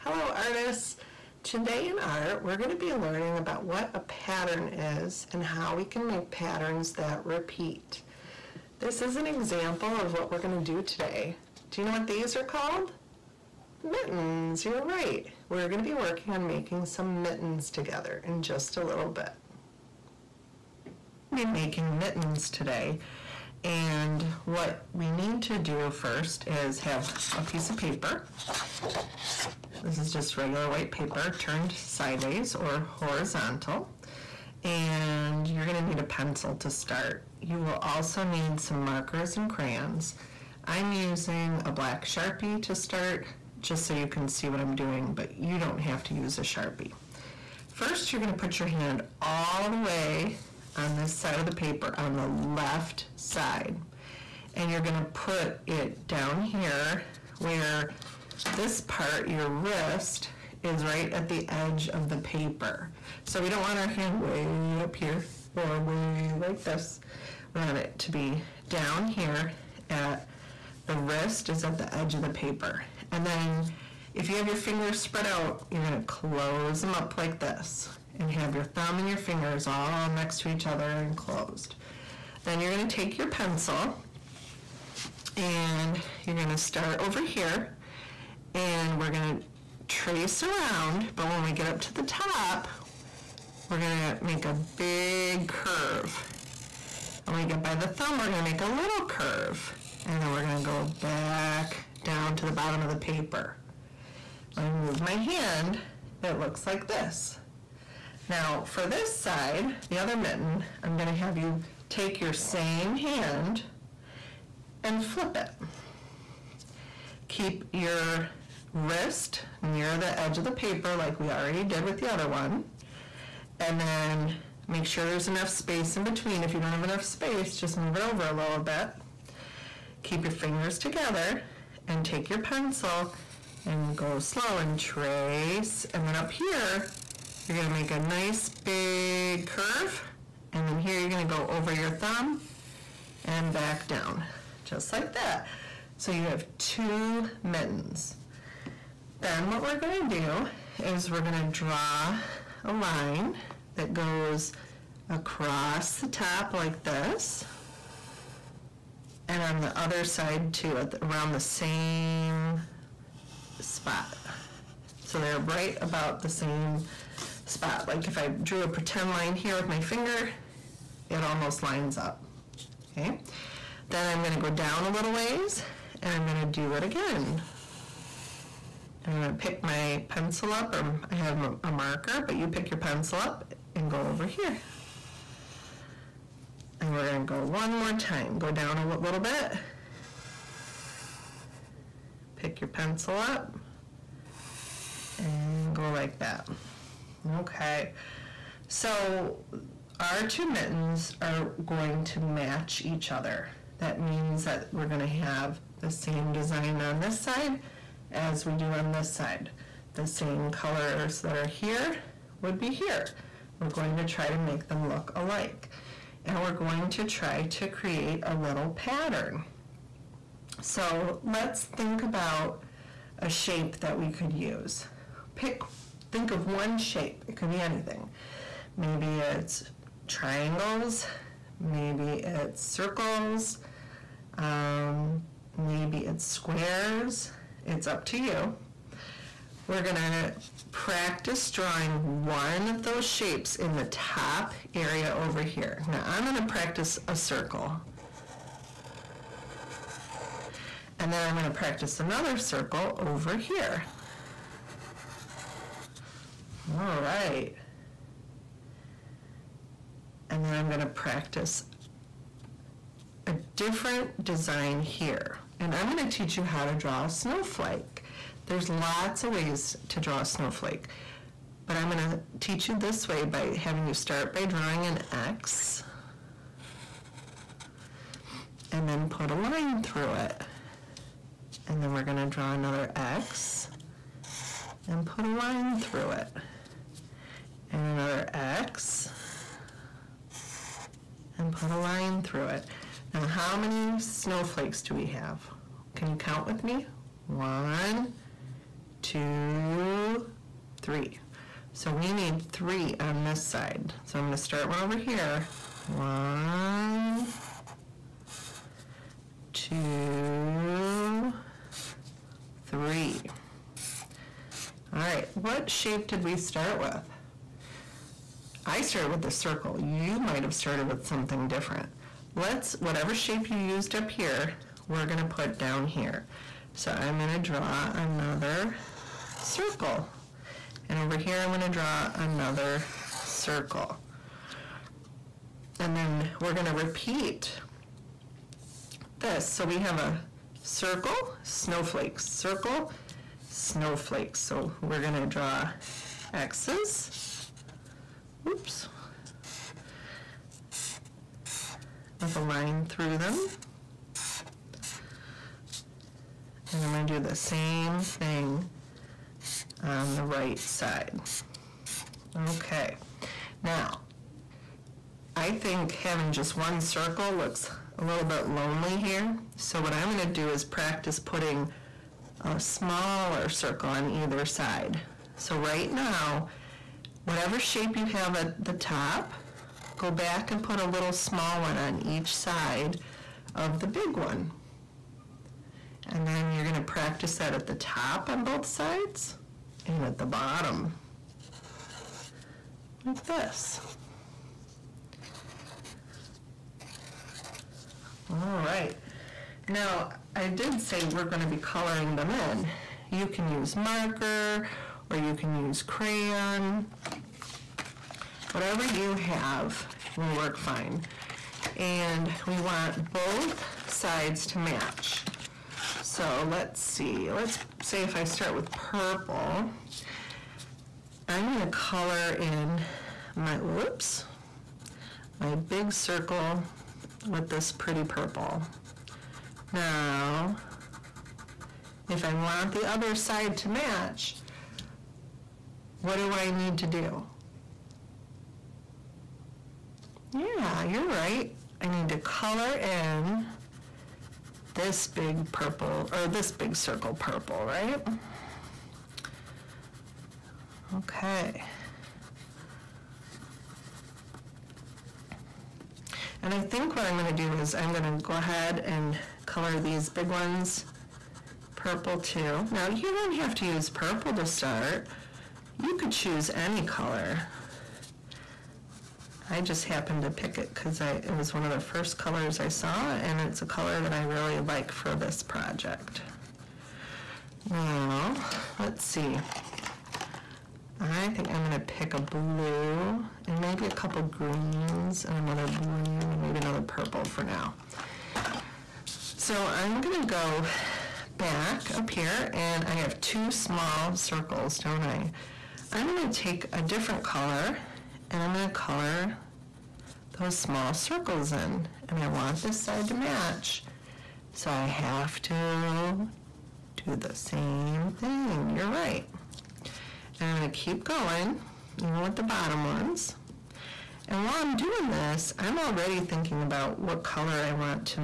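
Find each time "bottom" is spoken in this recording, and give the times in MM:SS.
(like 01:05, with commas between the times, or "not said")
01:42, 06:30, 08:32.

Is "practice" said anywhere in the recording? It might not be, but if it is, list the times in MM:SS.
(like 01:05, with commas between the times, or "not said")
04:00, 04:06, 04:11, 04:20, 06:10, 06:26.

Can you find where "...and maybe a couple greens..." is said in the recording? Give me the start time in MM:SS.
08:03.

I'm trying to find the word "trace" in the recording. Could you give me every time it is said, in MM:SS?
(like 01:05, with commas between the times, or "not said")
01:29, 02:14.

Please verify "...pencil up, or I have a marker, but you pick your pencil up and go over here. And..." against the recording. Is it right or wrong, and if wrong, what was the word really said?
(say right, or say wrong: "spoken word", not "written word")
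right.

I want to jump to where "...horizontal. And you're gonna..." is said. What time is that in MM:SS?
00:32.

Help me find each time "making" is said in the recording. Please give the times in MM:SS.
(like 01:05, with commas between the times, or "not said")
00:16, 00:21.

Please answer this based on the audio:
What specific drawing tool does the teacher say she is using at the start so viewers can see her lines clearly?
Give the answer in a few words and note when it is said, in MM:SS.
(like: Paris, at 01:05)
Black Sharpie, at 00:41.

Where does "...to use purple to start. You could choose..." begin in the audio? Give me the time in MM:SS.
07:43.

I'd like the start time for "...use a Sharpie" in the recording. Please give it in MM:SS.
00:46.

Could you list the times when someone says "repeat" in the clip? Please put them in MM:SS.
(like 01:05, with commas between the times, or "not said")
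00:07, 05:36.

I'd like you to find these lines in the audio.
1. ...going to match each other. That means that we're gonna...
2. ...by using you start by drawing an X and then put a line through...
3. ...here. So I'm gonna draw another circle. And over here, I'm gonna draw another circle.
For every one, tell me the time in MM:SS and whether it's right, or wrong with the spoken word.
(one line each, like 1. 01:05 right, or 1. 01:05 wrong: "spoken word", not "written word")
1. 03:21 right
2. 04:33 wrong: "having", not "using"
3. 05:25 right.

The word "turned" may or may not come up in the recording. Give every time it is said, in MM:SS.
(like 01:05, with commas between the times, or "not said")
00:31.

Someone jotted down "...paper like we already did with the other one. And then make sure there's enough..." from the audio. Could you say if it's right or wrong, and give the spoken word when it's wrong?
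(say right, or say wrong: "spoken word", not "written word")
right.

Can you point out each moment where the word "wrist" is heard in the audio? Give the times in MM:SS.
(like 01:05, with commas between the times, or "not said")
00:59, 01:10, 01:58.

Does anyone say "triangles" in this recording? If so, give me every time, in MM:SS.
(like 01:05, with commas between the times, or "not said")
03:50.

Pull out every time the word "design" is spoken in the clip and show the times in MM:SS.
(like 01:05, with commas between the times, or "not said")
03:26, 04:24.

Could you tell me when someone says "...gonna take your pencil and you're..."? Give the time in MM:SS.
01:22.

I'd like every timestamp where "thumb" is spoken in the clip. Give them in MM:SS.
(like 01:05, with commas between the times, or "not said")
01:18, 01:37, 02:21.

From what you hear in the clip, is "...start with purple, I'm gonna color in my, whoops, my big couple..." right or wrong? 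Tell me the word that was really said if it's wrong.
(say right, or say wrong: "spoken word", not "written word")
wrong: "circle", not "couple".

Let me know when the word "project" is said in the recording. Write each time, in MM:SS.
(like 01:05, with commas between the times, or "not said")
07:55.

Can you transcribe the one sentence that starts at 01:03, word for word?
So we don't want our hand way up here or way like this.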